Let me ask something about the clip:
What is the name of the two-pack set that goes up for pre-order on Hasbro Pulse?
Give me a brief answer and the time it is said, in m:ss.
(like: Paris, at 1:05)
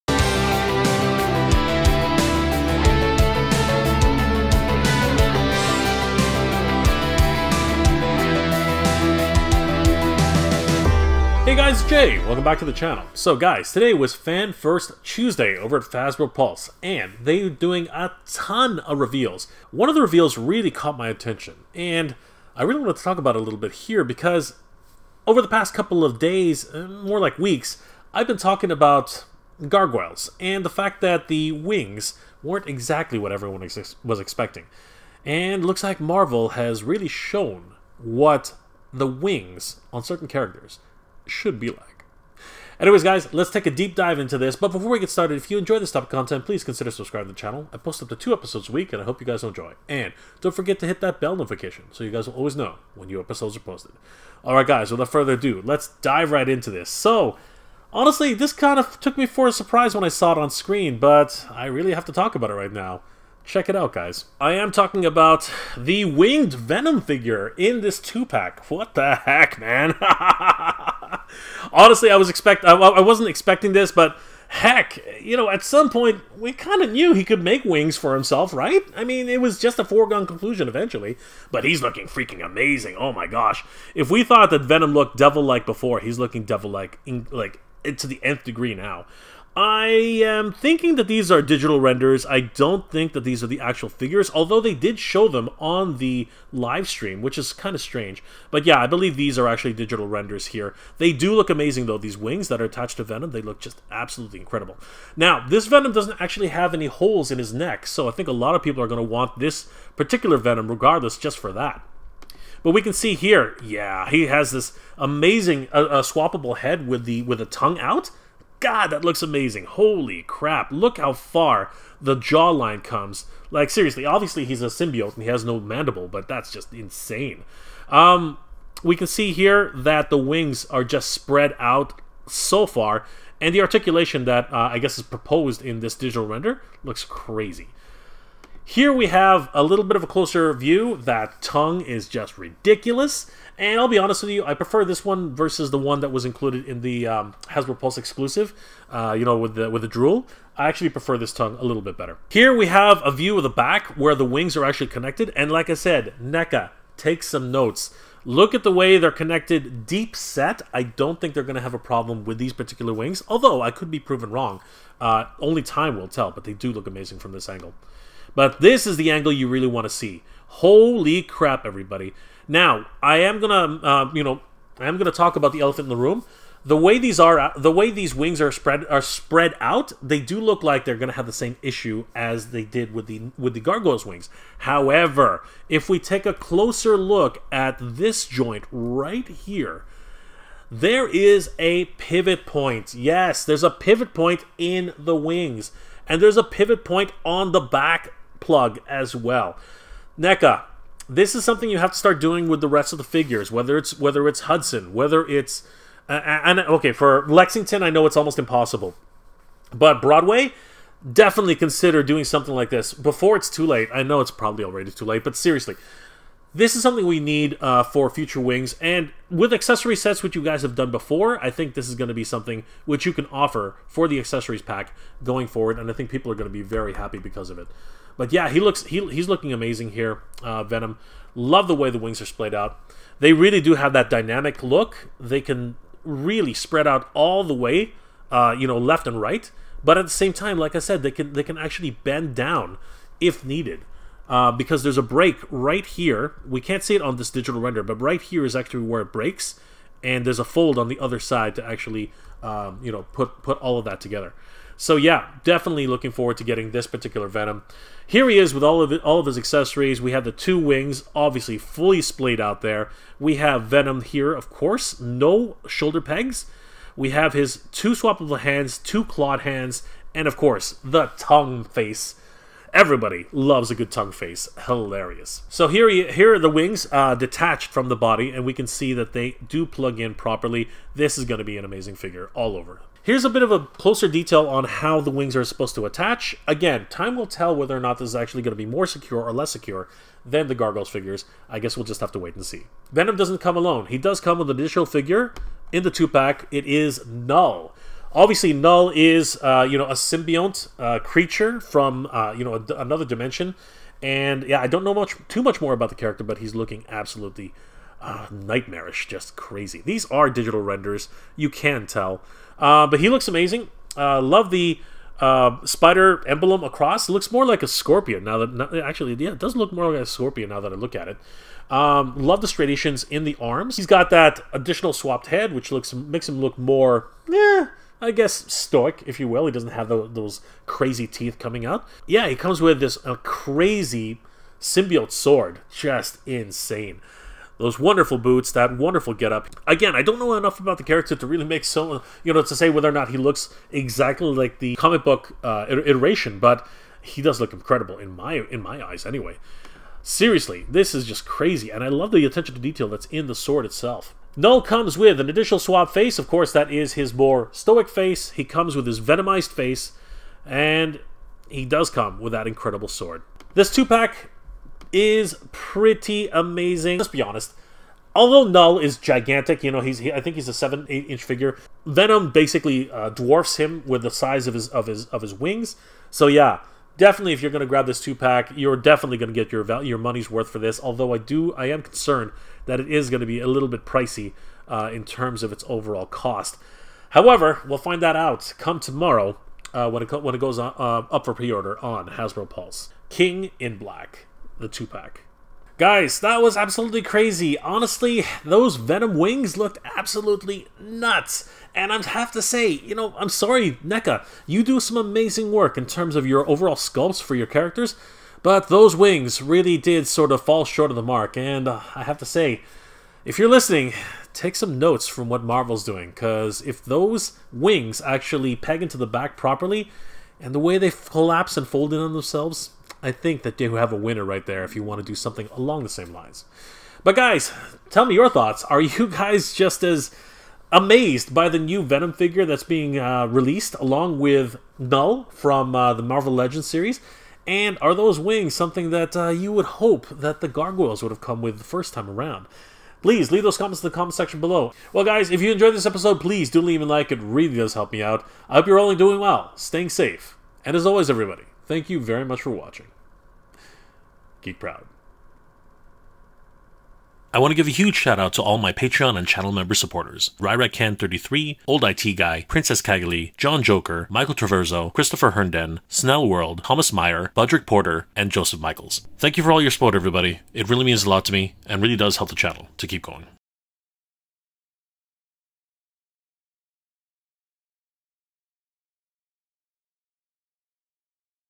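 King in Black, at 6:33.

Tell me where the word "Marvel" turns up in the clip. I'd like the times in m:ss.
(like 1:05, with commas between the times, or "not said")
0:36, 6:55, 7:16.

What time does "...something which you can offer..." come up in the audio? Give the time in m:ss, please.
3:42.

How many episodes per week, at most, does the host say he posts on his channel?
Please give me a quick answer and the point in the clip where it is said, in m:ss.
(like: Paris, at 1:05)
2, at 0:48.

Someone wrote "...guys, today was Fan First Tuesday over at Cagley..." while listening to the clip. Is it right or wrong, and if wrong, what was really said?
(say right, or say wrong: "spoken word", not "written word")
wrong: "Hasbro", not "Cagley".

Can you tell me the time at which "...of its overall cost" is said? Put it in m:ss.
6:25.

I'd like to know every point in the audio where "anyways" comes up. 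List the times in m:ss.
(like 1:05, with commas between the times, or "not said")
0:42, 5:49.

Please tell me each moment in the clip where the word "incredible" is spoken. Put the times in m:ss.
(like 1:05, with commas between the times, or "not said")
1:44, 5:47, 6:02.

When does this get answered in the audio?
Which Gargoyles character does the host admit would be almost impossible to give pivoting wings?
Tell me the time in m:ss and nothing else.
3:27.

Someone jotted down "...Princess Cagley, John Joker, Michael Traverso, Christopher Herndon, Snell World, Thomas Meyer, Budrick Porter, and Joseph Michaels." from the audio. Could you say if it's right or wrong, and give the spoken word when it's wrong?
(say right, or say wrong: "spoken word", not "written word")
right.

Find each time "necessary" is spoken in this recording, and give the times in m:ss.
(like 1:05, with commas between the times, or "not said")
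not said.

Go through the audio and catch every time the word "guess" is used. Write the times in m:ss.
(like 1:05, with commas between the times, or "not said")
2:14, 4:51, 5:28.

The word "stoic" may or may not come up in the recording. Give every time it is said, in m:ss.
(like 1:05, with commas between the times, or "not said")
5:28, 5:57.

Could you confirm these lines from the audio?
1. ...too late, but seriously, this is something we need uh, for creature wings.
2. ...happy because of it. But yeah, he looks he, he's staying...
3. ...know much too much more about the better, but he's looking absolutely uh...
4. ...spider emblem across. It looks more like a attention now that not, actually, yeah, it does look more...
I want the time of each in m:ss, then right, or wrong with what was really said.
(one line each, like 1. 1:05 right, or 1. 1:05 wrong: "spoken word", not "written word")
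1. 3:34 wrong: "future", not "creature"
2. 3:46 wrong: "looking", not "staying"
3. 5:04 wrong: "character", not "better"
4. 5:15 wrong: "scorpion", not "attention".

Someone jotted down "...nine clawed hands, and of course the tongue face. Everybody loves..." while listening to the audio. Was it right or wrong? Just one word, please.
wrong.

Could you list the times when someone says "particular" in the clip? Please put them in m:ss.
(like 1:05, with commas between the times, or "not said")
1:49, 2:42, 4:16.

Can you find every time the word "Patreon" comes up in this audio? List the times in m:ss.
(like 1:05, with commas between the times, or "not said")
7:38.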